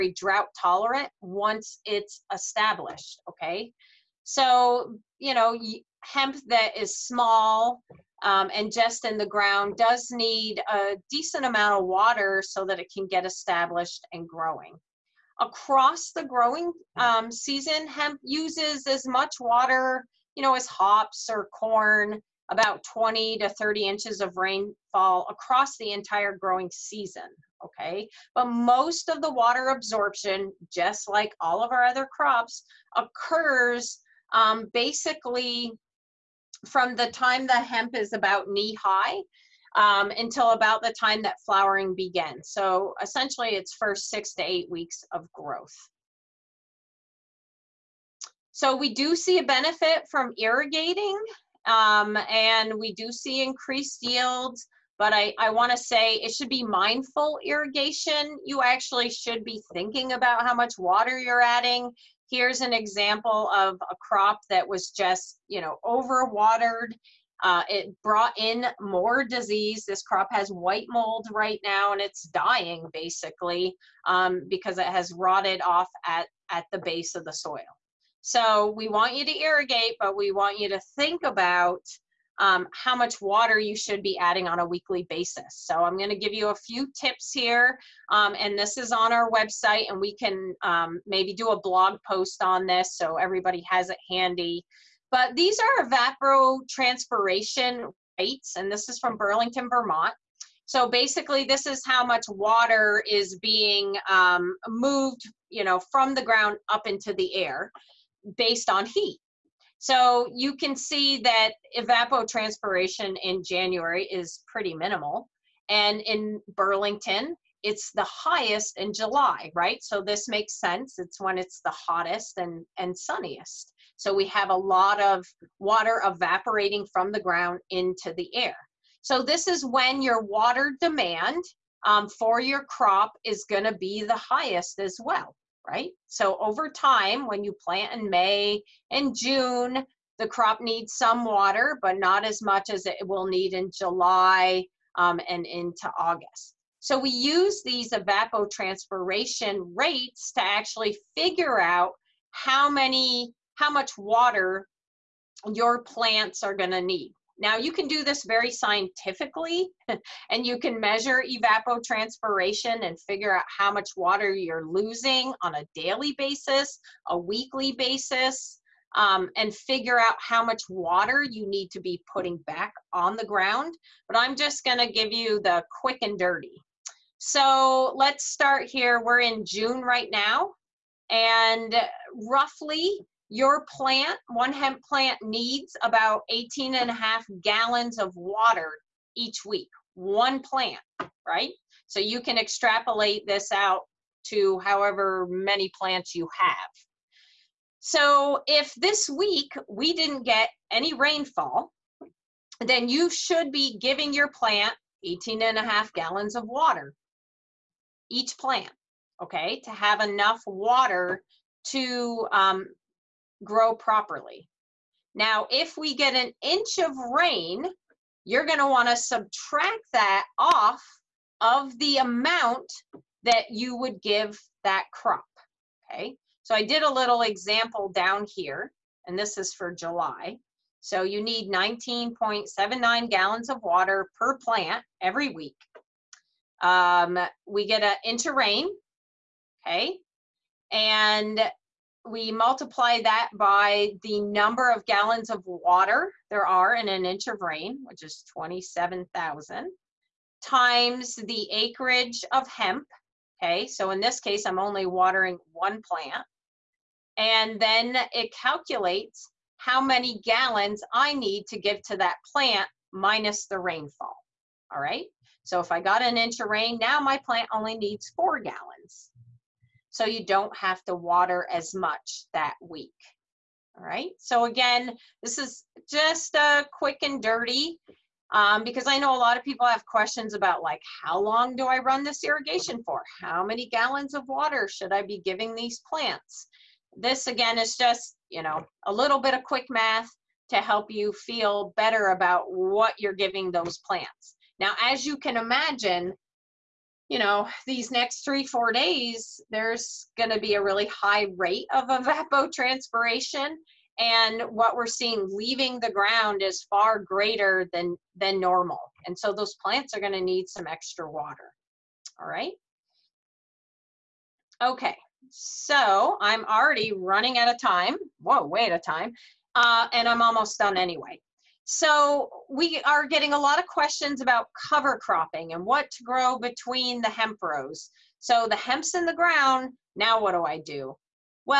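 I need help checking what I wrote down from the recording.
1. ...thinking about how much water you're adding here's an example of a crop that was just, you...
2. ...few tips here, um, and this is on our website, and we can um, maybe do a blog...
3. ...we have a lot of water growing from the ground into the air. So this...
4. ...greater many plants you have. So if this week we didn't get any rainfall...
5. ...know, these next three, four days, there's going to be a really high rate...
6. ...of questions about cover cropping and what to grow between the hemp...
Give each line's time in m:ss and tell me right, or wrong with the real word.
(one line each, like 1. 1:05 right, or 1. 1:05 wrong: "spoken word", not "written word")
1. 0:59 right
2. 1:26 right
3. 2:04 wrong: "evaporating", not "growing"
4. 3:14 wrong: "however", not "greater"
5. 4:57 right
6. 5:23 right.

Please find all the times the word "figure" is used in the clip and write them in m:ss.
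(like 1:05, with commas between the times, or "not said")
2:31, 2:43, 2:49.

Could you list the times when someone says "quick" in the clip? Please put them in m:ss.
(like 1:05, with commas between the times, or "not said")
2:55, 4:36, 4:49.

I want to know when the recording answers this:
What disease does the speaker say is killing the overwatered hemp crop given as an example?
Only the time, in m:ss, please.
1:10.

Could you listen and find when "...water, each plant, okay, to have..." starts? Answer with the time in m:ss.
3:26.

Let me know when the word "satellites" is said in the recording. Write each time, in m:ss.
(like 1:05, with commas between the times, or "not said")
not said.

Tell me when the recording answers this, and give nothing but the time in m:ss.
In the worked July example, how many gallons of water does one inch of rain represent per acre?
4:08.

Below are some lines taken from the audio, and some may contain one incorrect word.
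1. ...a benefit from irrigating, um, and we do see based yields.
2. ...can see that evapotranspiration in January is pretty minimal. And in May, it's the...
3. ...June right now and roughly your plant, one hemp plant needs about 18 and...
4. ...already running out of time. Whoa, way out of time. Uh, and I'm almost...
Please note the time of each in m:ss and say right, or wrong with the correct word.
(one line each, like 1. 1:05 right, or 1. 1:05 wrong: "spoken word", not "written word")
1. 0:49 wrong: "increased", not "based"
2. 1:50 wrong: "Burlington", not "May"
3. 2:59 right
4. 5:16 right.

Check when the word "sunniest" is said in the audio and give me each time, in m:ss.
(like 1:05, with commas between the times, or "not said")
2:02.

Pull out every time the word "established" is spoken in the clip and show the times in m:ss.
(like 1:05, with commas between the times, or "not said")
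0:02, 0:13.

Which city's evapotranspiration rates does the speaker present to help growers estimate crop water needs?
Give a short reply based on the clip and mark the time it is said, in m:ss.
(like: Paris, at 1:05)
Burlington, Vermont, at 1:39.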